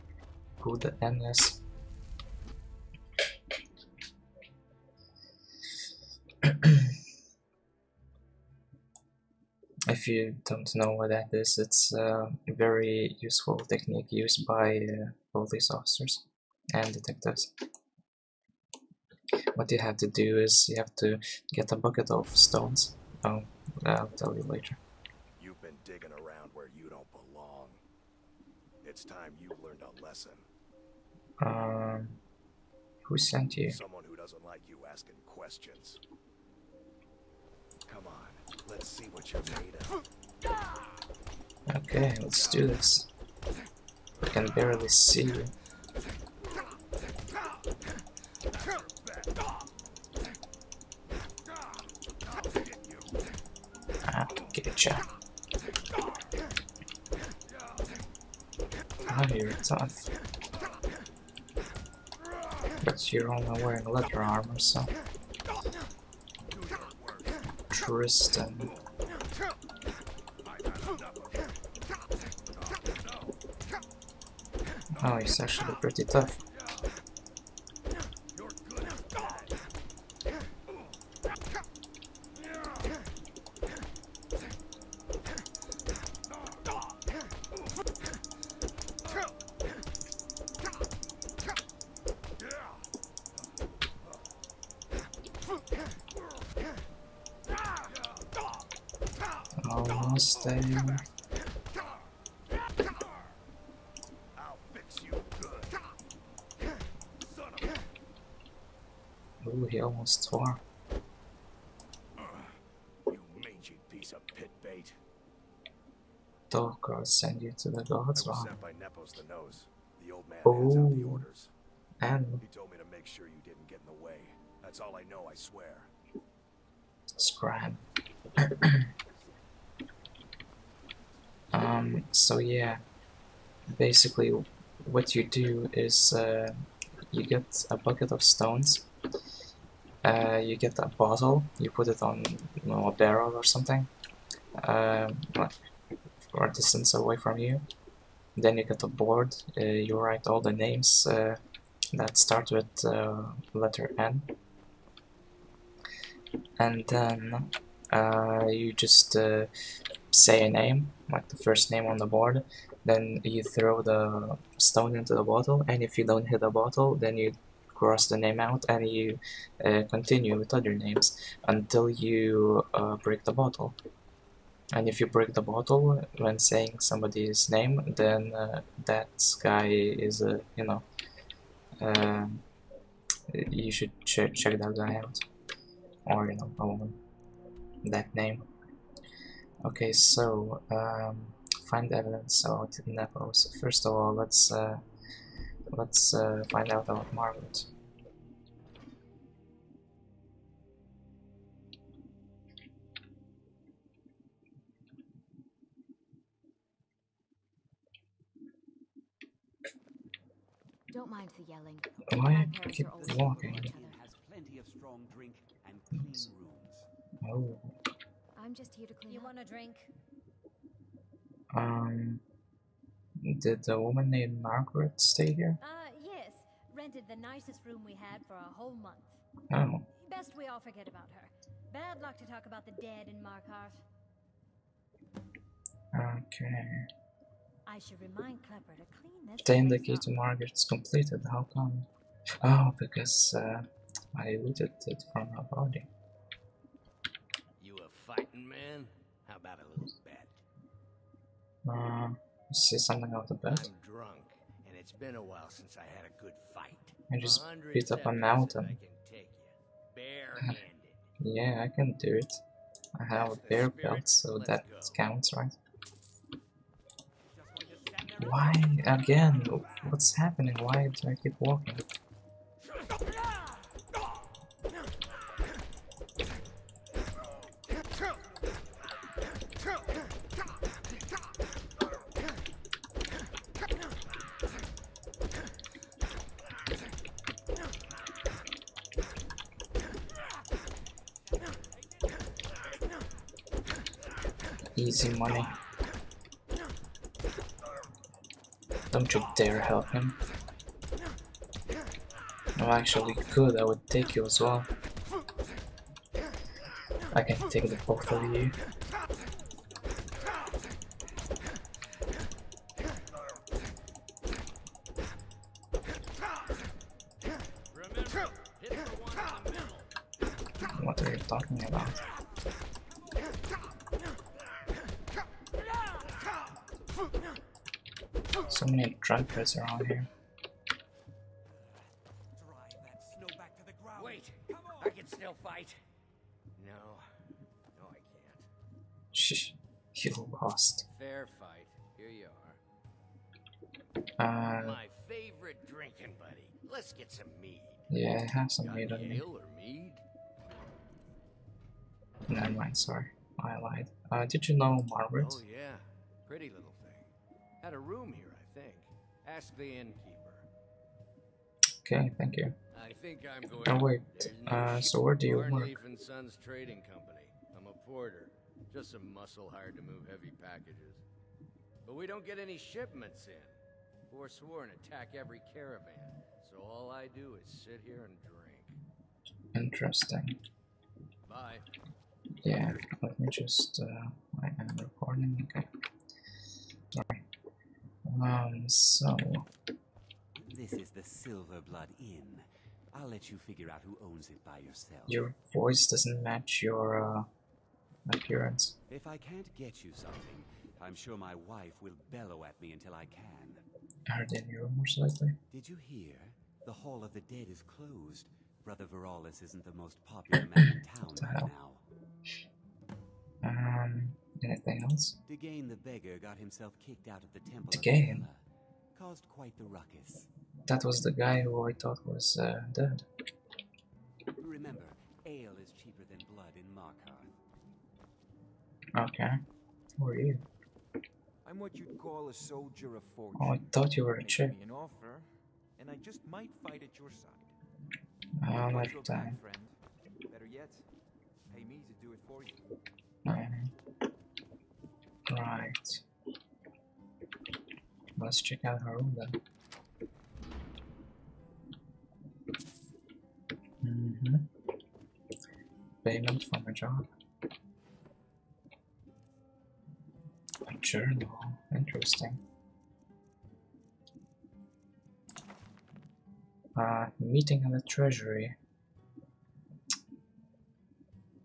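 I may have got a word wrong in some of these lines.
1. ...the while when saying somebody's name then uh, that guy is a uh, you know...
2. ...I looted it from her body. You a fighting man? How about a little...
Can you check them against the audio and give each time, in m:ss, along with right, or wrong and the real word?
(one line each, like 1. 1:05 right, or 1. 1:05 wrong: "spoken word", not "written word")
1. 2:55 wrong: "bottle", not "while"
2. 4:04 right.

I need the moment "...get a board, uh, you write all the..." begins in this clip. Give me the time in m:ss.
2:28.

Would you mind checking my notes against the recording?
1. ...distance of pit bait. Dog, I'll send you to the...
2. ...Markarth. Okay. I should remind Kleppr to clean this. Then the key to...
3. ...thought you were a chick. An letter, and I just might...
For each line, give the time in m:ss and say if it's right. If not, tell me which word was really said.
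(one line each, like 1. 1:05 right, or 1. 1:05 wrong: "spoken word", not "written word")
1. 1:53 wrong: "piece", not "distance"
2. 3:53 right
3. 7:13 wrong: "offer", not "letter".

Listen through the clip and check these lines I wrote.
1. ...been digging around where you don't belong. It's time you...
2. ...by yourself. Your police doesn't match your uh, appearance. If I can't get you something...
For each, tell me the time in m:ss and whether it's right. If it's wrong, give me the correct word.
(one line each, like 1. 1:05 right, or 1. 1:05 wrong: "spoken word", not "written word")
1. 0:25 right
2. 6:34 wrong: "voice", not "police".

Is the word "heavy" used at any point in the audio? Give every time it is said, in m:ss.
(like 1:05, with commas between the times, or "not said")
6:10.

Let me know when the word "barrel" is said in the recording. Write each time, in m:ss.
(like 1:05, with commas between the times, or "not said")
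2:22.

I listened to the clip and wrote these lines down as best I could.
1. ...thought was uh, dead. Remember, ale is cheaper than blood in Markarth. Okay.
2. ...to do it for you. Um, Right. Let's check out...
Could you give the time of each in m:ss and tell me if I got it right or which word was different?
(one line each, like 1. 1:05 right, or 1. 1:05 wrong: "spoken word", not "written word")
1. 7:01 right
2. 7:21 right.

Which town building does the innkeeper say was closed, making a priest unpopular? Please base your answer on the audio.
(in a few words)
The Hall of the Dead.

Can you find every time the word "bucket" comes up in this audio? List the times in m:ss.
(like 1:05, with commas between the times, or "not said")
0:21, 2:17.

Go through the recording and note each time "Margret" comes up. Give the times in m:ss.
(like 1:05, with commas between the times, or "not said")
3:44, 4:00, 5:54.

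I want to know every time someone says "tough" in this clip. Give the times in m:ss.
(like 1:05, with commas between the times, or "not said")
0:59, 1:16.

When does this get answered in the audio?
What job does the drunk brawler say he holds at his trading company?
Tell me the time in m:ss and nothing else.
6:07.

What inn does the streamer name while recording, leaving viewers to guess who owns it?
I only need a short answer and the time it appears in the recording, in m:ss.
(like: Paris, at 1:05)
Silver Blood Inn, at 6:31.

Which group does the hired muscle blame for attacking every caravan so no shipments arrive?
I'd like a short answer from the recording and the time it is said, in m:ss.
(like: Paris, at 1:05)
Forsworn, at 6:14.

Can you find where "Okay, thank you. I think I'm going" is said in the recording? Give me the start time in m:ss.
6:01.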